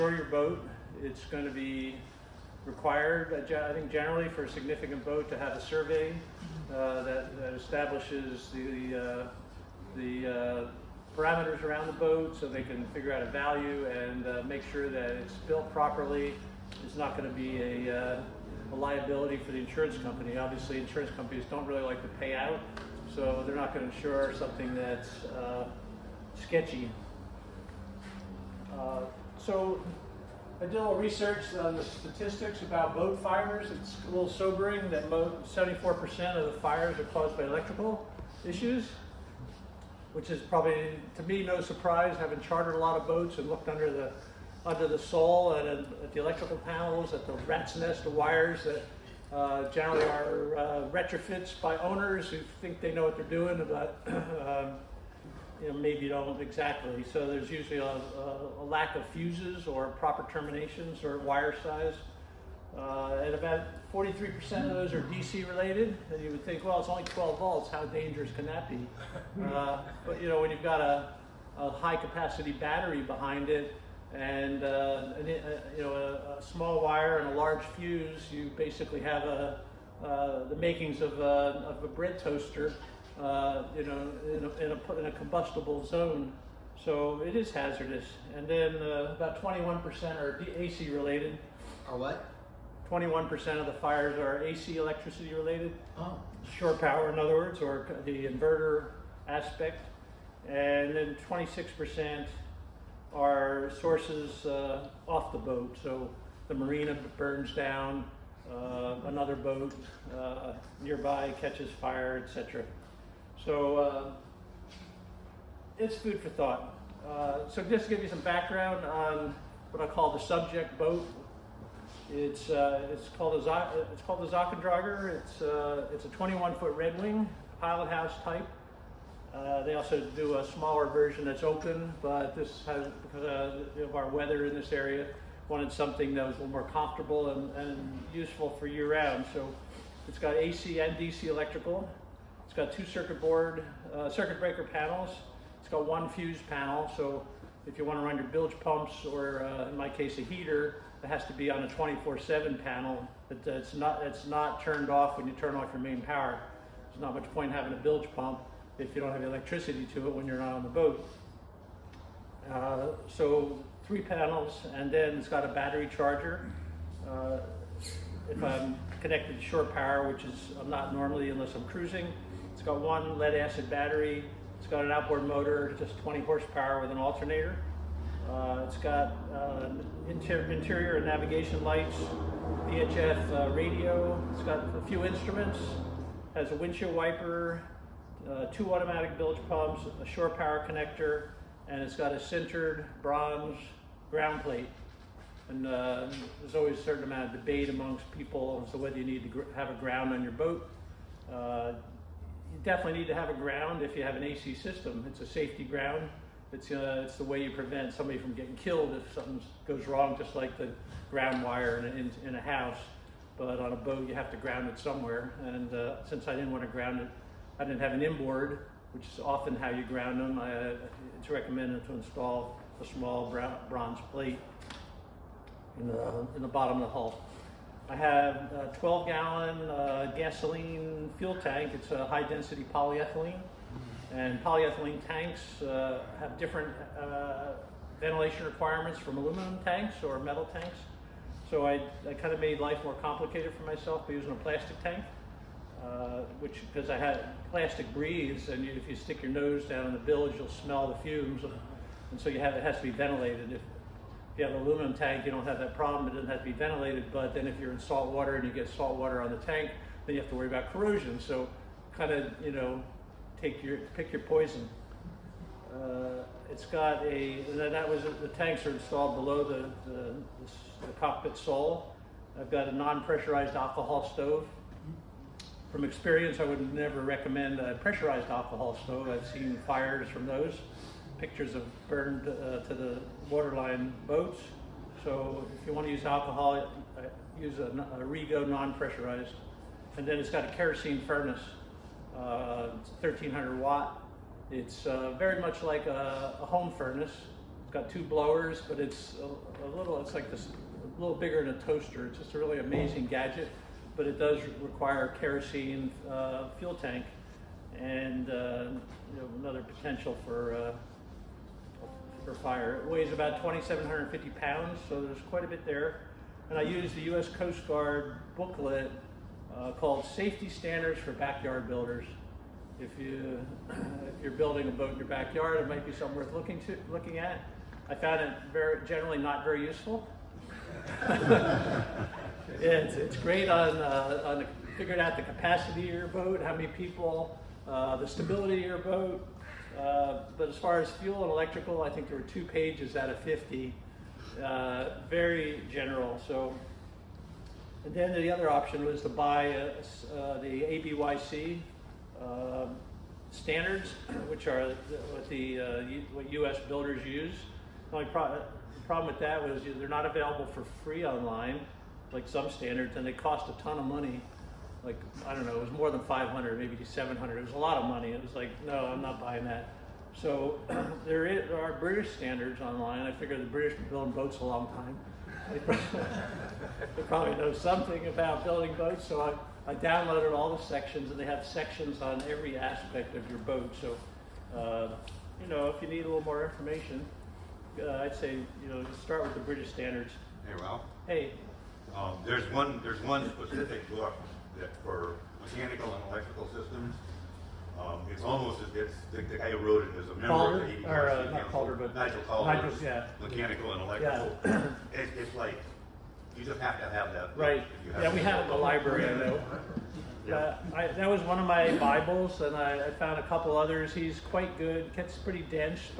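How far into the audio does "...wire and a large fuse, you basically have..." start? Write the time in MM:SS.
01:16.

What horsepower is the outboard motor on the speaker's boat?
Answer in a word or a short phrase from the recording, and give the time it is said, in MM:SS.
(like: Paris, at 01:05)
20 horsepower, at 02:56.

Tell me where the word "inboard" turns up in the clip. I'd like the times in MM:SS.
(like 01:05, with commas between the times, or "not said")
03:38.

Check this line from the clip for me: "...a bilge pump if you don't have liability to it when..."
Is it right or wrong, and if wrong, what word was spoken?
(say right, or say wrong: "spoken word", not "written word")
wrong: "electricity", not "liability".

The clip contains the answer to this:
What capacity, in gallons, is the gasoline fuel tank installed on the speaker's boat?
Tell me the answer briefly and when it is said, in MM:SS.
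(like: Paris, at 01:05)
12 gallons, at 03:48.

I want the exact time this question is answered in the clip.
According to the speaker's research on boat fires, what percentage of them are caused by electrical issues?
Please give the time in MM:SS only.
00:35.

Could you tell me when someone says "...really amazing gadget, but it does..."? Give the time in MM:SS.
05:02.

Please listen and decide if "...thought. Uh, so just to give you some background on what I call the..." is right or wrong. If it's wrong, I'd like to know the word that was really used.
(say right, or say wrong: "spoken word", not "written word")
right.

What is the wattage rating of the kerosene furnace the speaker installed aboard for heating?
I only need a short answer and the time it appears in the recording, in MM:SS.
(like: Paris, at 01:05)
1300 watts, at 04:53.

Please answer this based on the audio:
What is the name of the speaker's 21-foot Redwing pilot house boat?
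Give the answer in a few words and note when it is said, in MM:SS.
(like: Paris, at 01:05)
Zakkendragen, at 02:04.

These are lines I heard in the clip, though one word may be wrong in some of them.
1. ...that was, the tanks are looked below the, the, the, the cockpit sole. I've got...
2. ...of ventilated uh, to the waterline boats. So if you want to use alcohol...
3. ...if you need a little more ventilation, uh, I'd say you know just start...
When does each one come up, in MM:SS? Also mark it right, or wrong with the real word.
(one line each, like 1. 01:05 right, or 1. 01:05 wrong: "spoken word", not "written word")
1. 04:27 wrong: "installed", not "looked"
2. 04:41 wrong: "burned", not "ventilated"
3. 06:25 wrong: "information", not "ventilation".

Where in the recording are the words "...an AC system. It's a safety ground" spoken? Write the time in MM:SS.
03:24.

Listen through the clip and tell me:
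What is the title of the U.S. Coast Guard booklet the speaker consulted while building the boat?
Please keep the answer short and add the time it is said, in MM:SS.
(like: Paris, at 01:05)
Safety Standards for Backyard Builders, at 05:20.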